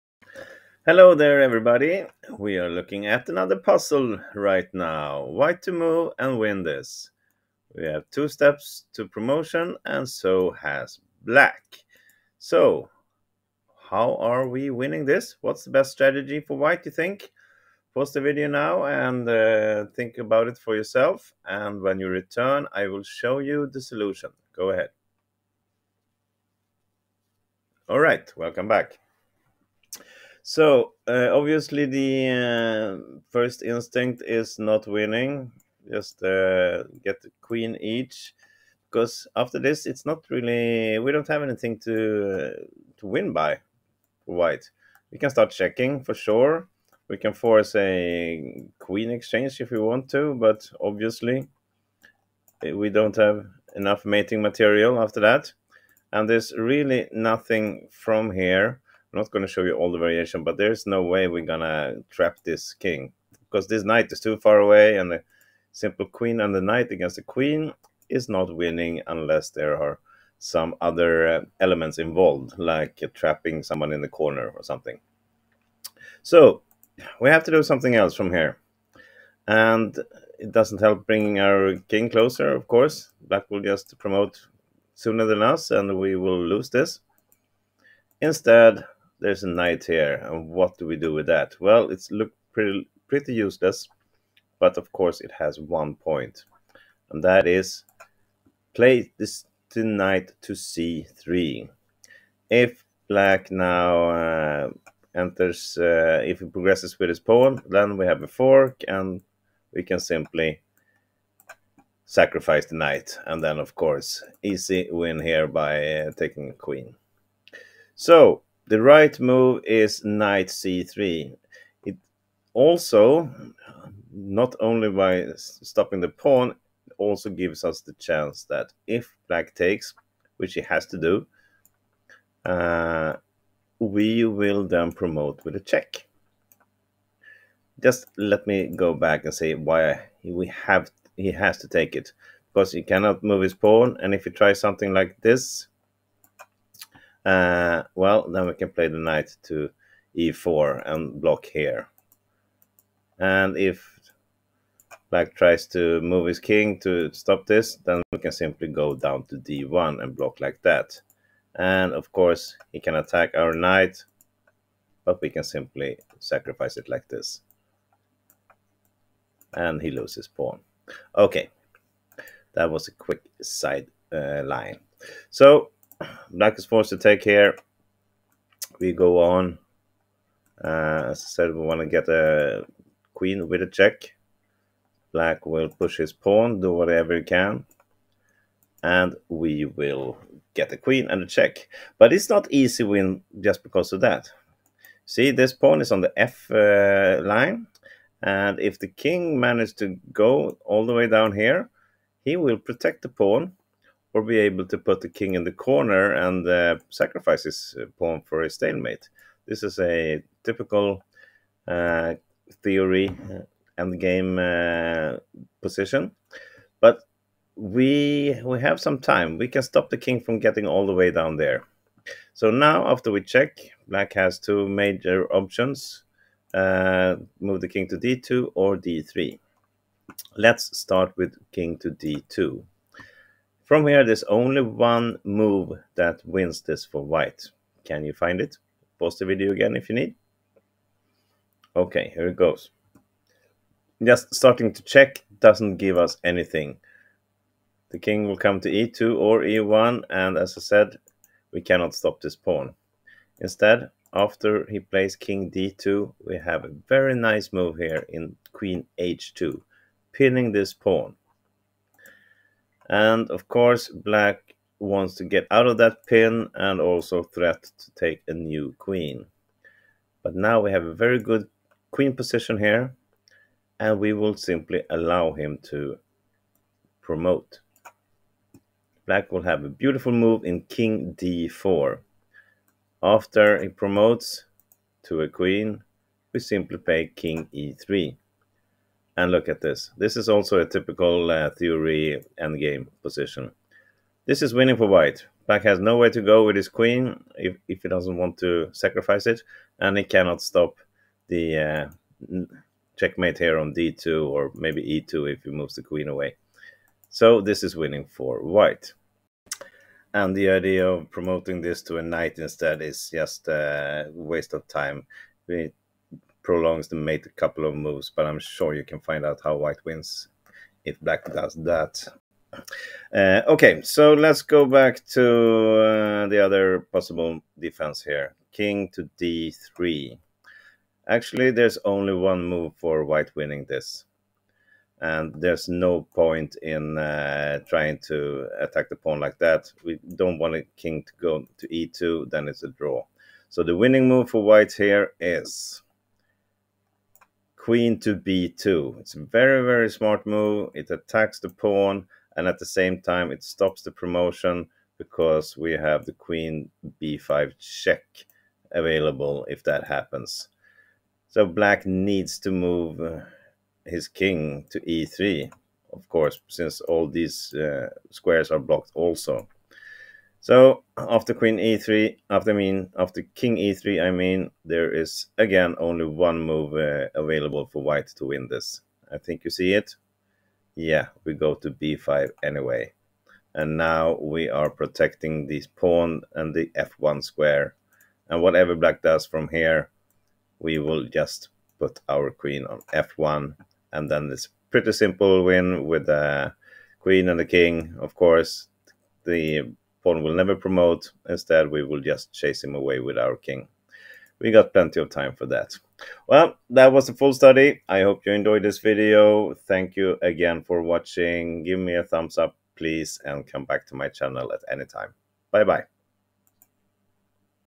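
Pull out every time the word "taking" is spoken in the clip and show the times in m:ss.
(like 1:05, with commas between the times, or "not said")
1:56.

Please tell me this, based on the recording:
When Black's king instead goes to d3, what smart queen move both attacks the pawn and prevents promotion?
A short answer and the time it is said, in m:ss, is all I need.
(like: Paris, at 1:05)
Qb2, at 5:47.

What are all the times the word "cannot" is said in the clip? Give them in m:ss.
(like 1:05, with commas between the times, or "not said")
2:22, 4:11, 5:00.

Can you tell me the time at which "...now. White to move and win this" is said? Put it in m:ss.
0:04.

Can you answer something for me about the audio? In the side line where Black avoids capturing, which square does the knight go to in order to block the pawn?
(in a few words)
e4.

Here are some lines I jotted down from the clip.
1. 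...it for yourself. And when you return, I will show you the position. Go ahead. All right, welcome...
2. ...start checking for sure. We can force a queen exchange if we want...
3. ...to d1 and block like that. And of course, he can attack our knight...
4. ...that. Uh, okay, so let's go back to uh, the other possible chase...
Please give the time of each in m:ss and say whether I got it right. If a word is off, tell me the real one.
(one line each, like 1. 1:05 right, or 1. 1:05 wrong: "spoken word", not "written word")
1. 0:20 wrong: "solution", not "position"
2. 0:45 right
3. 2:39 right
4. 5:21 wrong: "defense", not "chase".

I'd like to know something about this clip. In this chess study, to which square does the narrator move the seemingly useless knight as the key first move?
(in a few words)
c3.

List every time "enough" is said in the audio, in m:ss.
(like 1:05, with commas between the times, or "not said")
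0:53.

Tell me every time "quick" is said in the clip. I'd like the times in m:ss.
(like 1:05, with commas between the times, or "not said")
2:52.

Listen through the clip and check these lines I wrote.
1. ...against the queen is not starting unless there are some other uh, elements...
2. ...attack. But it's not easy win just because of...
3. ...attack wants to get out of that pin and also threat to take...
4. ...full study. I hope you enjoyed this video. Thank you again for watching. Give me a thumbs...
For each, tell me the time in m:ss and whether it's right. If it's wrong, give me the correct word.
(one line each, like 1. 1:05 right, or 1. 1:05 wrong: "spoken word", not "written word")
1. 1:06 wrong: "winning", not "starting"
2. 3:11 wrong: "check", not "attack"
3. 4:23 wrong: "black", not "attack"
4. 6:47 right.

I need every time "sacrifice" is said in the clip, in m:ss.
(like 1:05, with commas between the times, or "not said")
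1:52, 2:46, 3:26, 4:58.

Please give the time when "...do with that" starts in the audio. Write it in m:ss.
1:30.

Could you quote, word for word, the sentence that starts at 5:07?
So this is winning for white.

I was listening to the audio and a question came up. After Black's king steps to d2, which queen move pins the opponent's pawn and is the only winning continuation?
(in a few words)
Qh2.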